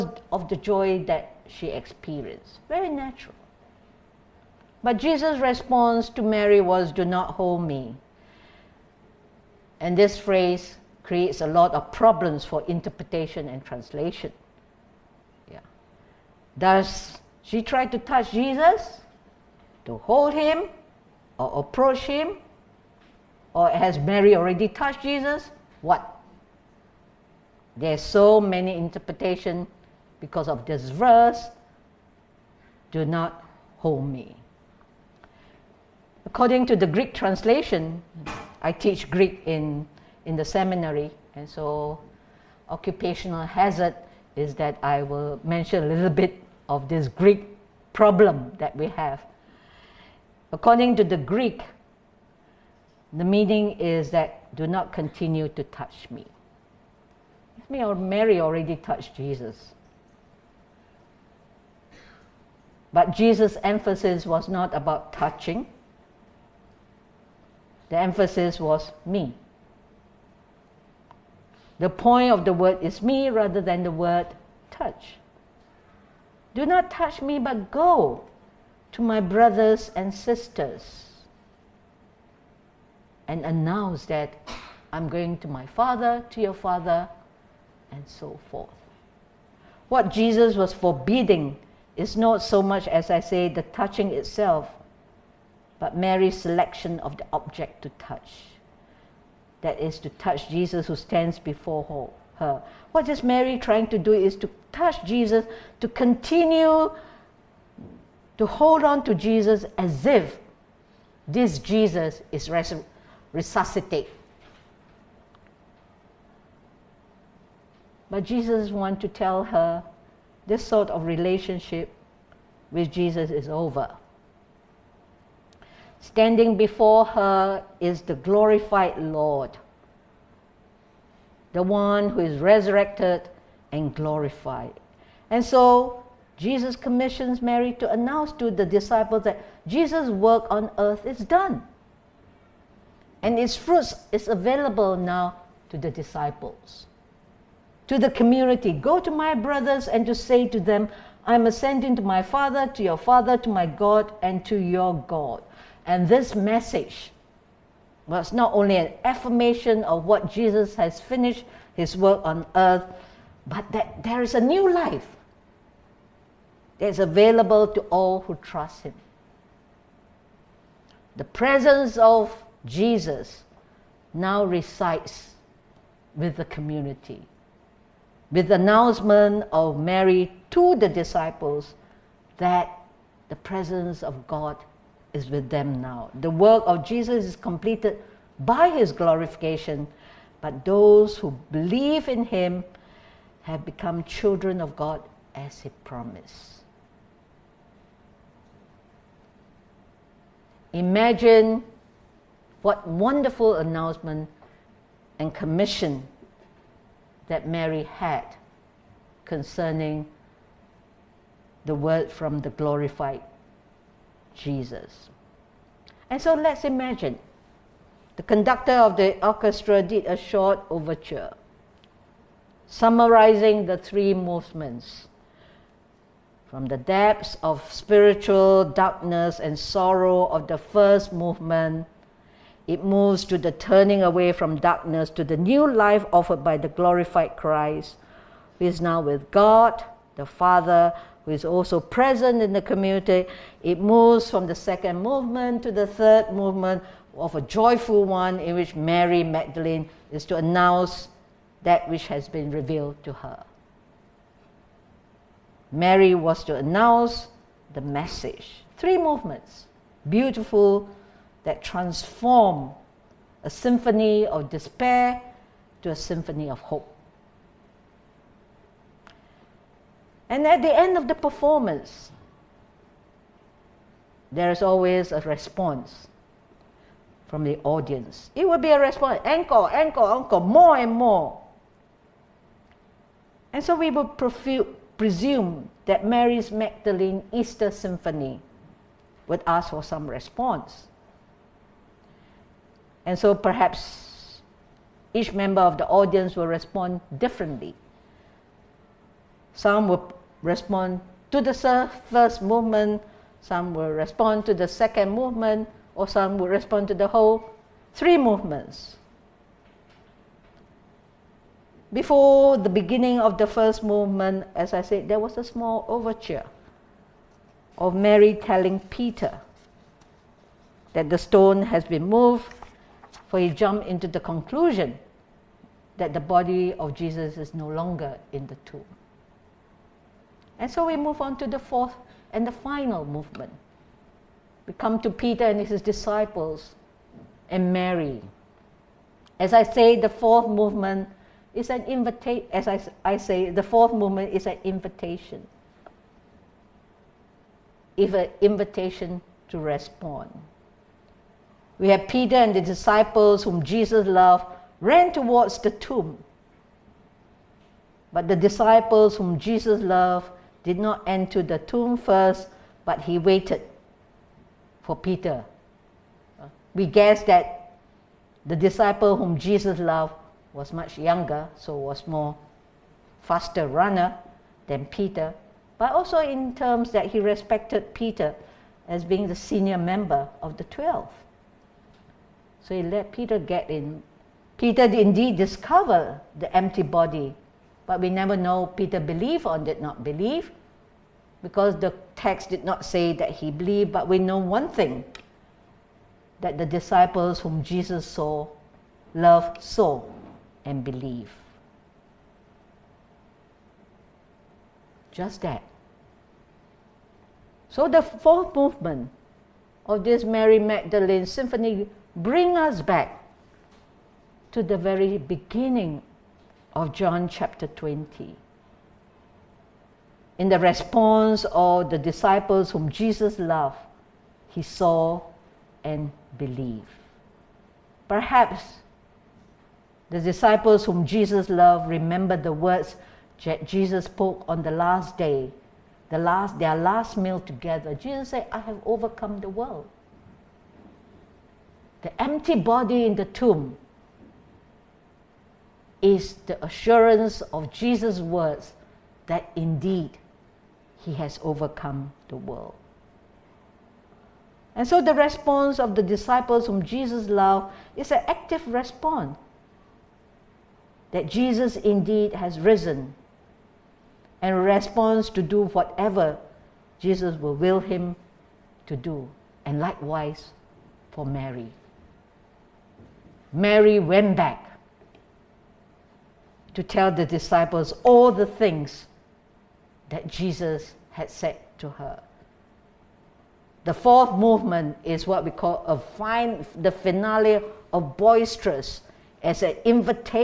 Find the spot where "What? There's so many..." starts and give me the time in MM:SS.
00:25.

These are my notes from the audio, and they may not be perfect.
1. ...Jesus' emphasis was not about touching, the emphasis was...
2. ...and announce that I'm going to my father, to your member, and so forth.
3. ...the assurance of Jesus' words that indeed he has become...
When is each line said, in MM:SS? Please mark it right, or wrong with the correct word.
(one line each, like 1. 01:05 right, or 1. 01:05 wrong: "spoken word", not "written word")
1. 01:03 right
2. 01:23 wrong: "father", not "member"
3. 07:26 wrong: "overcome", not "become".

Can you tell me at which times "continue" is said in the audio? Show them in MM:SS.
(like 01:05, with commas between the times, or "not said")
00:54, 01:45.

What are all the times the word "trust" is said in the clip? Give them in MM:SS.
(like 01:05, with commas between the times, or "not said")
02:48.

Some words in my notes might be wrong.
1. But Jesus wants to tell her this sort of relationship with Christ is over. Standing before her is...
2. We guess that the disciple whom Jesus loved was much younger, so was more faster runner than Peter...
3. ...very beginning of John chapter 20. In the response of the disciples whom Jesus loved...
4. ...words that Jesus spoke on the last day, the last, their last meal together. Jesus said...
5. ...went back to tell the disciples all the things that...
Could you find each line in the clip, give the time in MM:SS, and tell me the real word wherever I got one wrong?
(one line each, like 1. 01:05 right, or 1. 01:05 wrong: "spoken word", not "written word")
1. 01:58 wrong: "Jesus", not "Christ"
2. 06:06 right
3. 06:54 right
4. 07:12 right
5. 07:53 right.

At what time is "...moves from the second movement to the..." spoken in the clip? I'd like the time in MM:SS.
04:03.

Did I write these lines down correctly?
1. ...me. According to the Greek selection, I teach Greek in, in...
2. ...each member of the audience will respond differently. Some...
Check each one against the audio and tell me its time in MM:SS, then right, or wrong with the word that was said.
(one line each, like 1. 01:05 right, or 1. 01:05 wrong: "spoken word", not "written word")
1. 00:34 wrong: "translation", not "selection"
2. 04:55 right.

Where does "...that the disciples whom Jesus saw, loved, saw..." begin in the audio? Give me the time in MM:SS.
06:36.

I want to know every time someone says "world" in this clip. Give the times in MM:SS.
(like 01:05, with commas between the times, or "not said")
07:19, 07:32.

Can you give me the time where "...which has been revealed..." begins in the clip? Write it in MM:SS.
04:11.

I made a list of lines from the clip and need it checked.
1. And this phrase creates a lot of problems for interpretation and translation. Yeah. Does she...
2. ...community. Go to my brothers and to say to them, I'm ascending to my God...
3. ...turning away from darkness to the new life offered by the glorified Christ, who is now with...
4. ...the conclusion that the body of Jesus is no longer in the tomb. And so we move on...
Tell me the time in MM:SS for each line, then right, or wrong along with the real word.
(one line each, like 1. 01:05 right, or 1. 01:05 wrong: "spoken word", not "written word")
1. 00:09 right
2. 02:28 wrong: "Father", not "God"
3. 03:53 right
4. 05:24 right.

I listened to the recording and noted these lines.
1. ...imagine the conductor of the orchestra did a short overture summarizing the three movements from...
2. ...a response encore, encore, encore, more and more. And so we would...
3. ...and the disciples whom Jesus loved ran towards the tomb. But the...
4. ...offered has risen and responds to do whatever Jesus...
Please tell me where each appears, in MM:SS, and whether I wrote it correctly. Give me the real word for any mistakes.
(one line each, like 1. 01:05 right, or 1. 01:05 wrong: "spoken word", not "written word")
1. 03:36 right
2. 04:38 right
3. 05:52 right
4. 07:41 wrong: "indeed", not "offered".